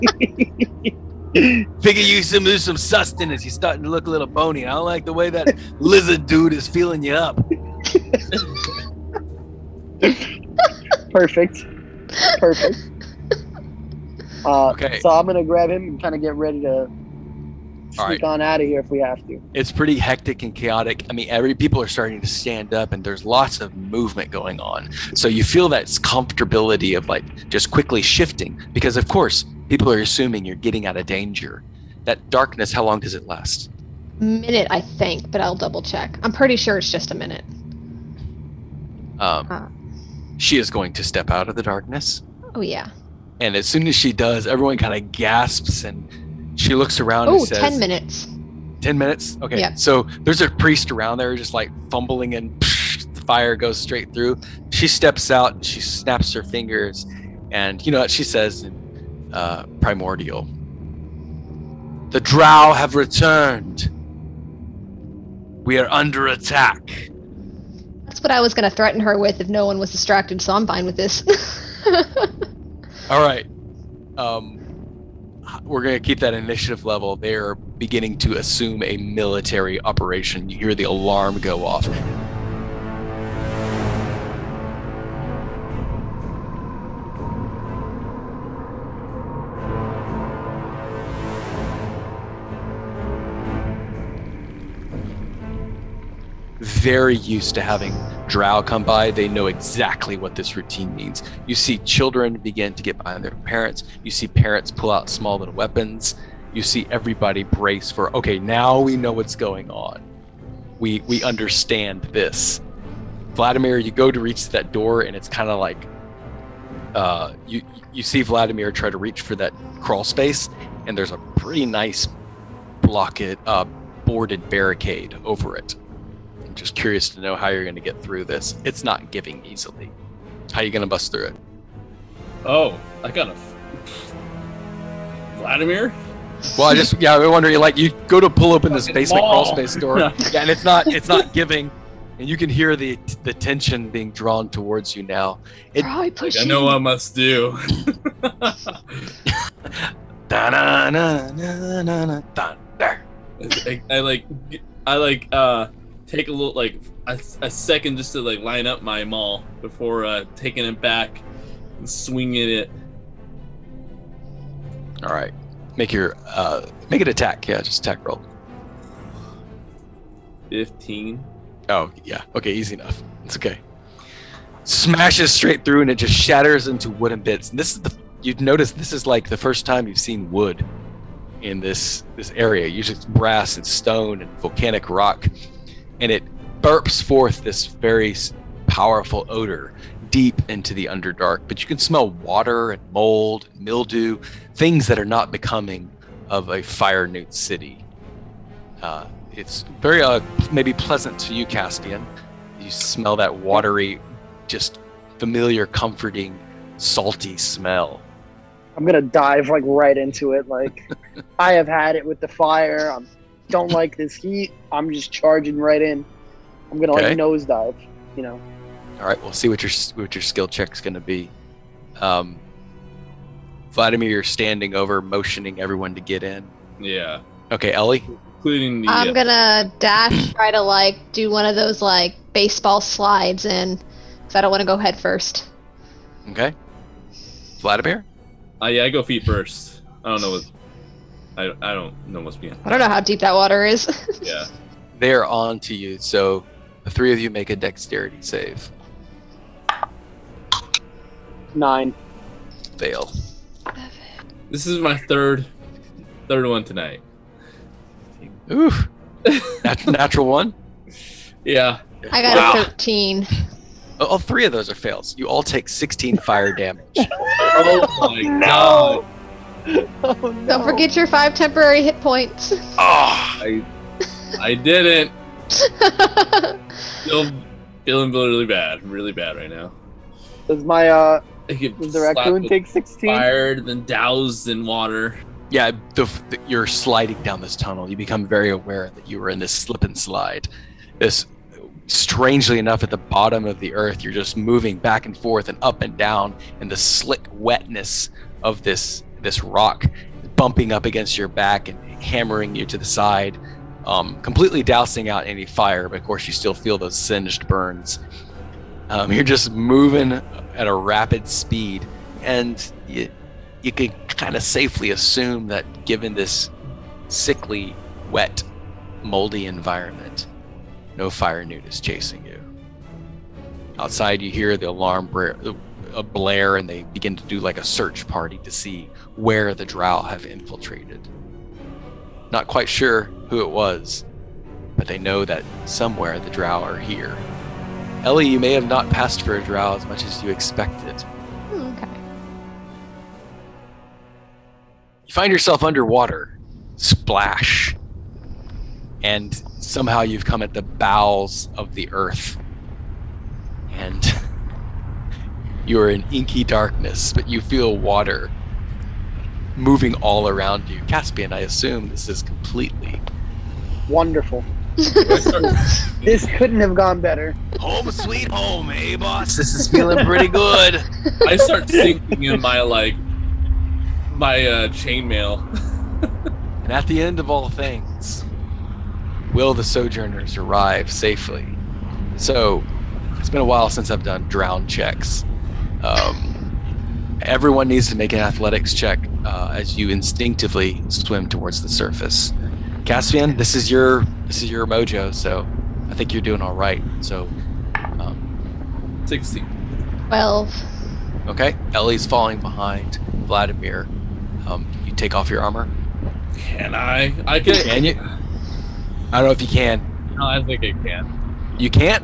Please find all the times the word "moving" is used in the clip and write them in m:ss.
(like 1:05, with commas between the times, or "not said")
4:54, 5:09, 5:59.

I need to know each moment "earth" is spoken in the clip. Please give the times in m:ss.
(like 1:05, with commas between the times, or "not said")
4:53, 5:51.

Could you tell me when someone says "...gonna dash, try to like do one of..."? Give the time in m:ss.
3:49.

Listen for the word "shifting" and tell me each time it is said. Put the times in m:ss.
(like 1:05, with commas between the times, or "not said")
0:28.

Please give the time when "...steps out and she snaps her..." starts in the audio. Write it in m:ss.
0:54.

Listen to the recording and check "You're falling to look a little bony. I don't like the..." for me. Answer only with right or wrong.
wrong.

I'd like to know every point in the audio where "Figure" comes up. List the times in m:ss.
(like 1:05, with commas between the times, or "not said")
0:01.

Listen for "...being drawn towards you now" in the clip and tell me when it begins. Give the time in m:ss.
2:23.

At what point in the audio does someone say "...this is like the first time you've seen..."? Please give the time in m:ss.
2:58.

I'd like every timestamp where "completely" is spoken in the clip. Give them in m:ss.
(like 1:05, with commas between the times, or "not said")
5:04, 6:02.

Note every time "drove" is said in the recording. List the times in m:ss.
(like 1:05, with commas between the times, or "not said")
not said.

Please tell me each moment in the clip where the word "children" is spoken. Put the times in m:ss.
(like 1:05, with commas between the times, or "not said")
1:41.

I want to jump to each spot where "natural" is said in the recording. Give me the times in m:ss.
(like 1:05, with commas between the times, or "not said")
4:19.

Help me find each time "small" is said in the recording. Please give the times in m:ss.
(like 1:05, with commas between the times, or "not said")
1:45.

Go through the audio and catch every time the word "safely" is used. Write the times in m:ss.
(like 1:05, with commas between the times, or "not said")
5:14, 6:20.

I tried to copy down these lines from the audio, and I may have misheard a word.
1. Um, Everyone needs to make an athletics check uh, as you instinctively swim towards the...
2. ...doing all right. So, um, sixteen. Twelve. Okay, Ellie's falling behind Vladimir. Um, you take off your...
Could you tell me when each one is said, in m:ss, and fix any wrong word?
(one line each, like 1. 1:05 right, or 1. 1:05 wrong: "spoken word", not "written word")
1. 6:25 right
2. 6:36 right.